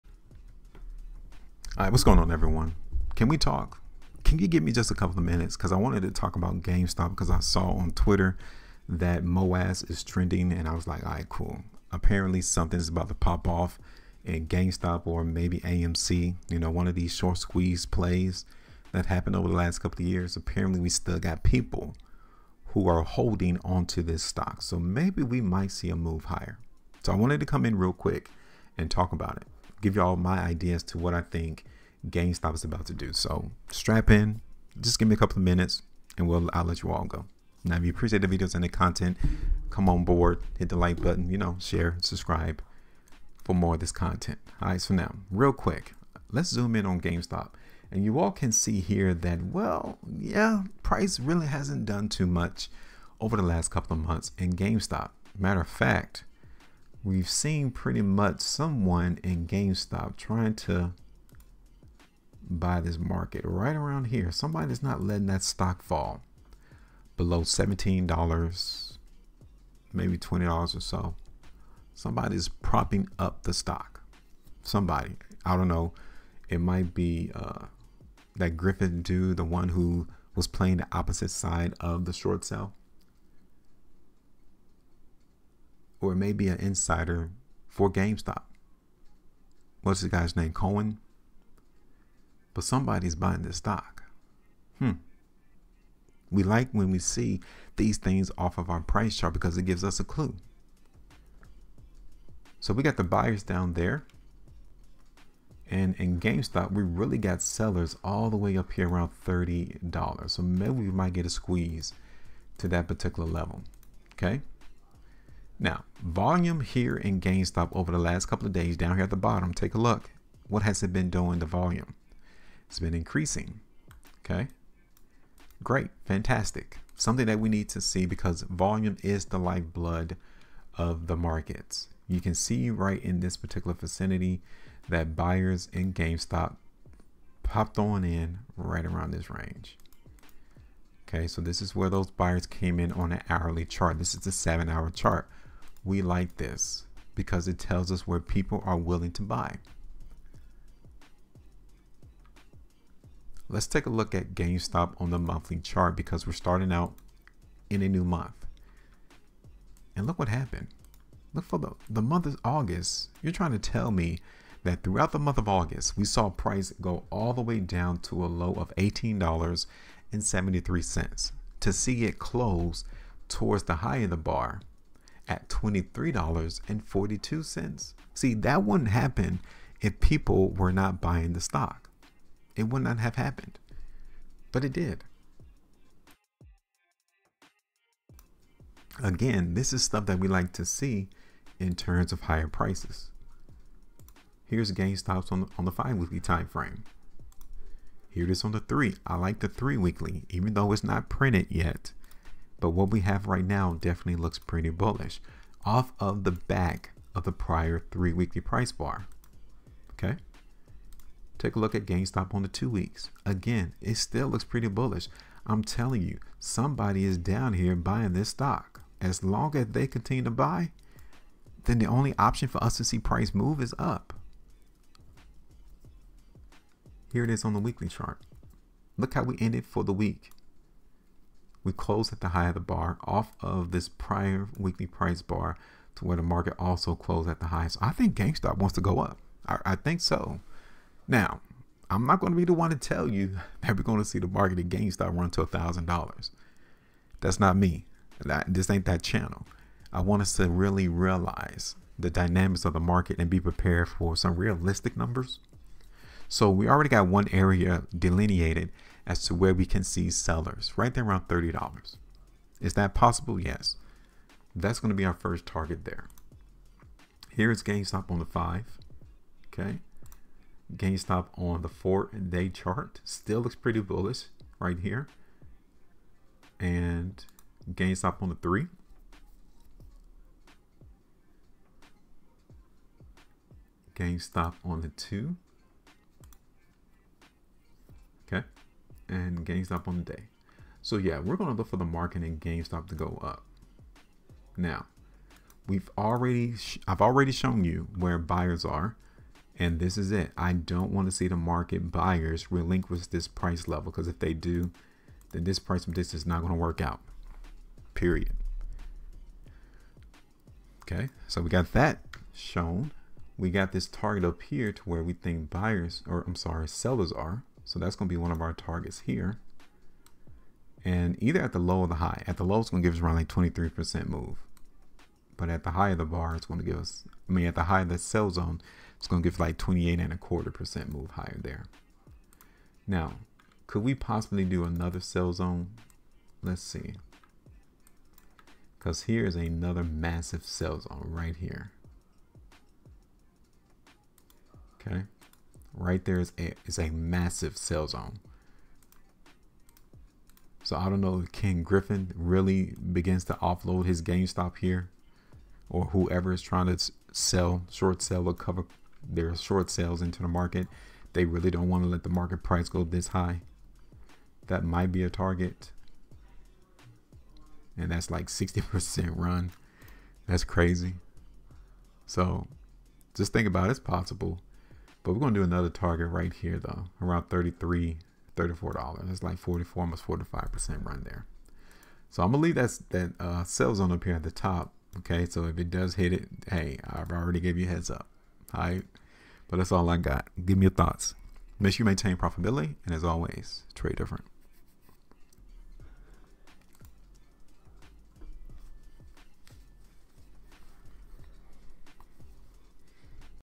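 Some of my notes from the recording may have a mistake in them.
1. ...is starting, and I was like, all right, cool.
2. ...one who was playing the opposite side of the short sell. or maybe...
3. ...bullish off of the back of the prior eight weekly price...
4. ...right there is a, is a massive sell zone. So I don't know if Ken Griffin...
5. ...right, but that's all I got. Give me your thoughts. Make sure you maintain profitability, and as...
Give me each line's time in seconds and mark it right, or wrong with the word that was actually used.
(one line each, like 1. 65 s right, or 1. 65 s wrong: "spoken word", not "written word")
1. 9 s wrong: "trending", not "starting"
2. 79 s right
3. 204 s wrong: "three", not "eight"
4. 345 s right
5. 388 s right.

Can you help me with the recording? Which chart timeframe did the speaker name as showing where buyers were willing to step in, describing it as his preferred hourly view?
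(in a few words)
seven hour chart.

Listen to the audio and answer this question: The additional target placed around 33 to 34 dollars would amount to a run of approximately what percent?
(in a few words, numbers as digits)
45%.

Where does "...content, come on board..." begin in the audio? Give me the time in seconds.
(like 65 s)
38 s.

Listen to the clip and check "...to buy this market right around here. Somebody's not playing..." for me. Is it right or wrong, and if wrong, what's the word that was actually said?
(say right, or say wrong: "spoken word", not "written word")
wrong: "letting", not "playing".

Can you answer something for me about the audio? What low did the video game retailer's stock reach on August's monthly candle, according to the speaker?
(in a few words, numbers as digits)
$18.73.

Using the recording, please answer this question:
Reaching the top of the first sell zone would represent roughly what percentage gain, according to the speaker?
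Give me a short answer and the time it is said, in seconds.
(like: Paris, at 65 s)
28.25%, at 329 s.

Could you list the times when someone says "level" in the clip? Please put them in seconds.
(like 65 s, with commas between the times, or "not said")
113 s, 303 s.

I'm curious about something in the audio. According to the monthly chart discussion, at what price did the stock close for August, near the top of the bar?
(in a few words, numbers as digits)
$23.42.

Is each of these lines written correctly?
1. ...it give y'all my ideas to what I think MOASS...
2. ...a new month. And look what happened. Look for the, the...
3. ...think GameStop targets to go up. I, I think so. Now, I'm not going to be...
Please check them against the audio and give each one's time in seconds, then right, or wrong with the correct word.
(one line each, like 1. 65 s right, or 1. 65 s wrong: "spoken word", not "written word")
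1. 29 s wrong: "GameStop", not "MOASS"
2. 157 s right
3. 237 s wrong: "wants", not "targets".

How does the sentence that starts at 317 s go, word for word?
So that's going to be one of our targets here.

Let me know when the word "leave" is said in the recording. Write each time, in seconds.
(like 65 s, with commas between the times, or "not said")
382 s.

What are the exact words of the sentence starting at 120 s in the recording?
What has it been doing The volume?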